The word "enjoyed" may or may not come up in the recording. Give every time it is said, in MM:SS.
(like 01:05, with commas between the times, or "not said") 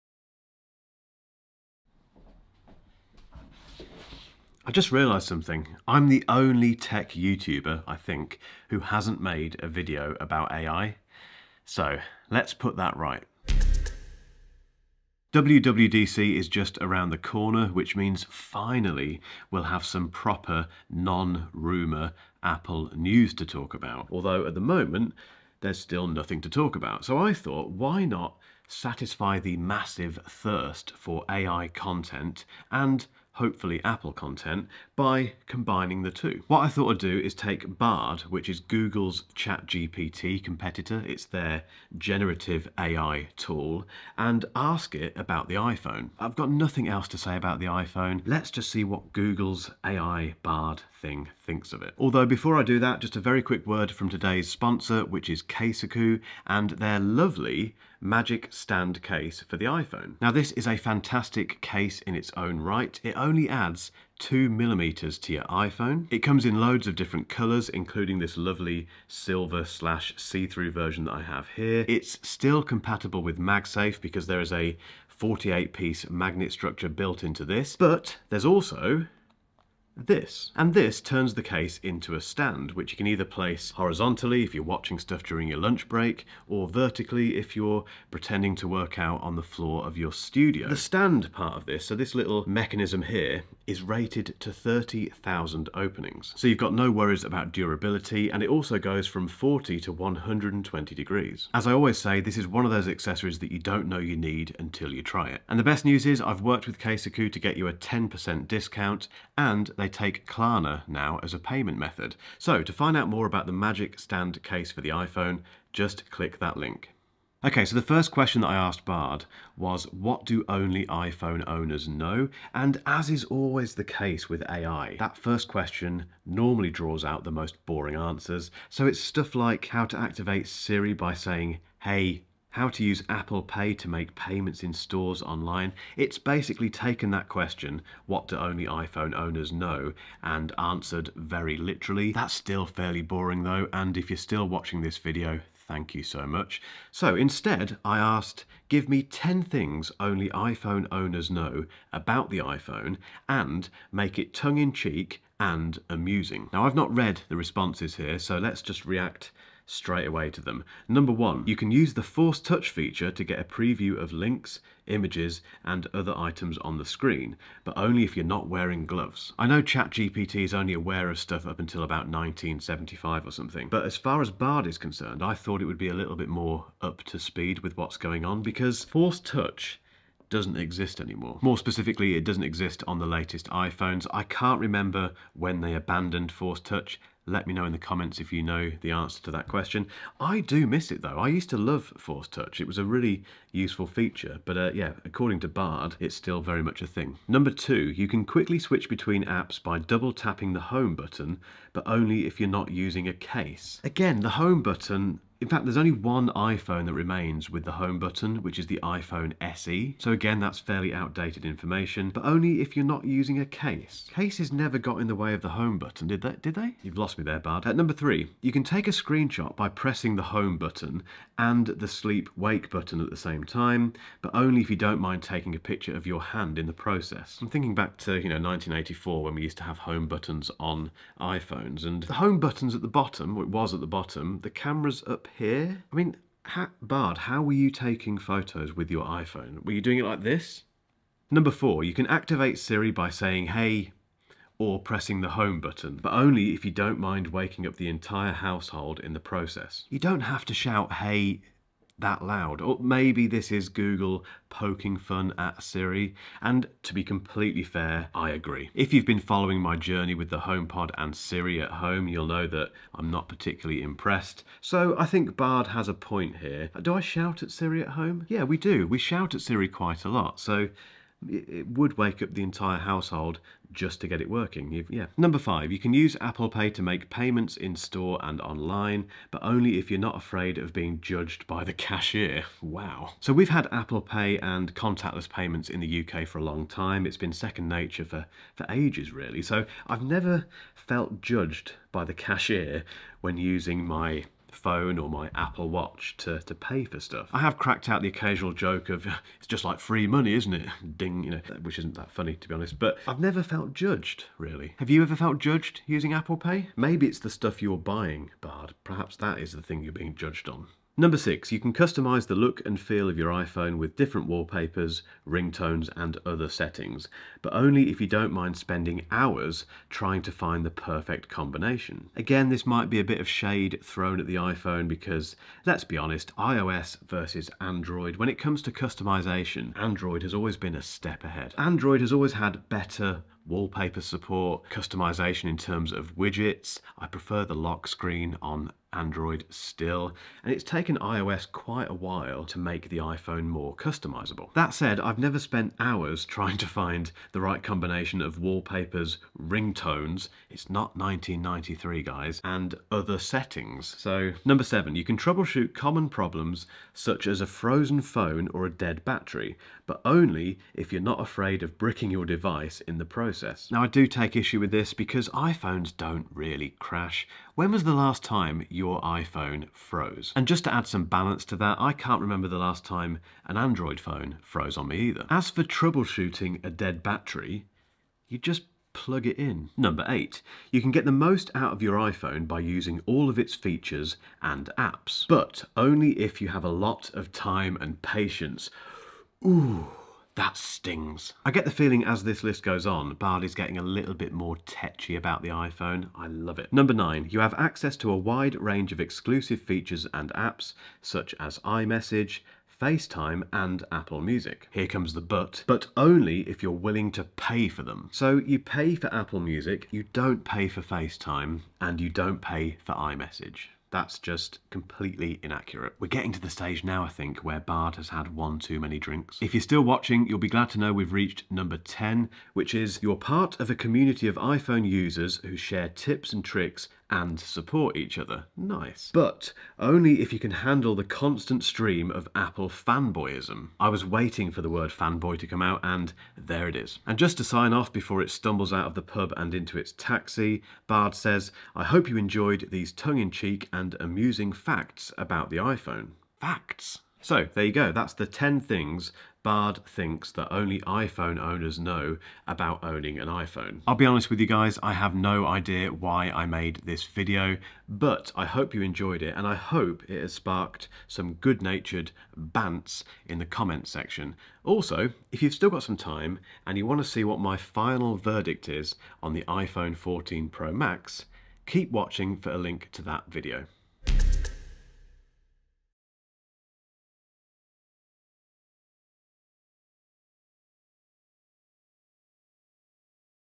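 07:22, 07:38.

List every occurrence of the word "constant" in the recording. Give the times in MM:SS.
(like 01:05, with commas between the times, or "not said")
07:11.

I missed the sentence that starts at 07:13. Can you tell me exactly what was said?
I was waiting for the word fanboy to come out, and there it is.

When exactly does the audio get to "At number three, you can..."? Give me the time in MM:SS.
03:37.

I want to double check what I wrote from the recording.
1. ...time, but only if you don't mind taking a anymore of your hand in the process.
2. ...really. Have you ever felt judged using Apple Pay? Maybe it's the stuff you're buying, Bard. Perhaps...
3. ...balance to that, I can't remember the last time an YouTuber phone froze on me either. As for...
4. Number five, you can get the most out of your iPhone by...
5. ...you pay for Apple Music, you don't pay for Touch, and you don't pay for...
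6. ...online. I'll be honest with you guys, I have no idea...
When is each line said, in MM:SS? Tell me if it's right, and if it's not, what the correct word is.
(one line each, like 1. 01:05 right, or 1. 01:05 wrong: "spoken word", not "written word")
1. 03:43 wrong: "picture", not "anymore"
2. 05:04 right
3. 06:11 wrong: "Android", not "YouTuber"
4. 06:19 wrong: "eight", not "five"
5. 06:48 wrong: "FaceTime", not "Touch"
6. 07:33 wrong: "iPhone", not "online".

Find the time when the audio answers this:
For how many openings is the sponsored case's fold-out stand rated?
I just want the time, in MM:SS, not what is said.
01:34.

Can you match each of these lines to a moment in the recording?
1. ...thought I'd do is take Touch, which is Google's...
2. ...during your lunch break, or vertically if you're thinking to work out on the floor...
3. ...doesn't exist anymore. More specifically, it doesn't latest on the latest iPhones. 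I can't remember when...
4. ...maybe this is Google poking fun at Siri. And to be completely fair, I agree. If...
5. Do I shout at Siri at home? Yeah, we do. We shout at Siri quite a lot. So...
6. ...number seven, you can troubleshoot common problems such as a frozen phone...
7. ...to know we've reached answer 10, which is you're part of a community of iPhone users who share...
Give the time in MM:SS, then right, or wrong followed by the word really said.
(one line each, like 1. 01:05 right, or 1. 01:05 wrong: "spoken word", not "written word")
1. 00:36 wrong: "Bard", not "Touch"
2. 01:25 wrong: "pretending", not "thinking"
3. 03:00 wrong: "exist", not "latest"
4. 04:12 right
5. 04:26 right
6. 05:54 right
7. 07:00 wrong: "number", not "answer".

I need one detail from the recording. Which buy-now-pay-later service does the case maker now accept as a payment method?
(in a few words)
Klarna.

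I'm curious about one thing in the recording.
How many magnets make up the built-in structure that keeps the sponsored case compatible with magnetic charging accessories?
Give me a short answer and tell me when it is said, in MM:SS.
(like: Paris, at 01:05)
48, at 01:15.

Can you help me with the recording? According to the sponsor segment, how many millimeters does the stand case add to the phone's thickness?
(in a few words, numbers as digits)
2.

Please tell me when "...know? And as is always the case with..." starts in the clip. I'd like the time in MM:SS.
02:01.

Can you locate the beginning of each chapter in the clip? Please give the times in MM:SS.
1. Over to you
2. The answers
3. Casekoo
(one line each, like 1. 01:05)
1. 07:27
2. 01:57
3. 00:52.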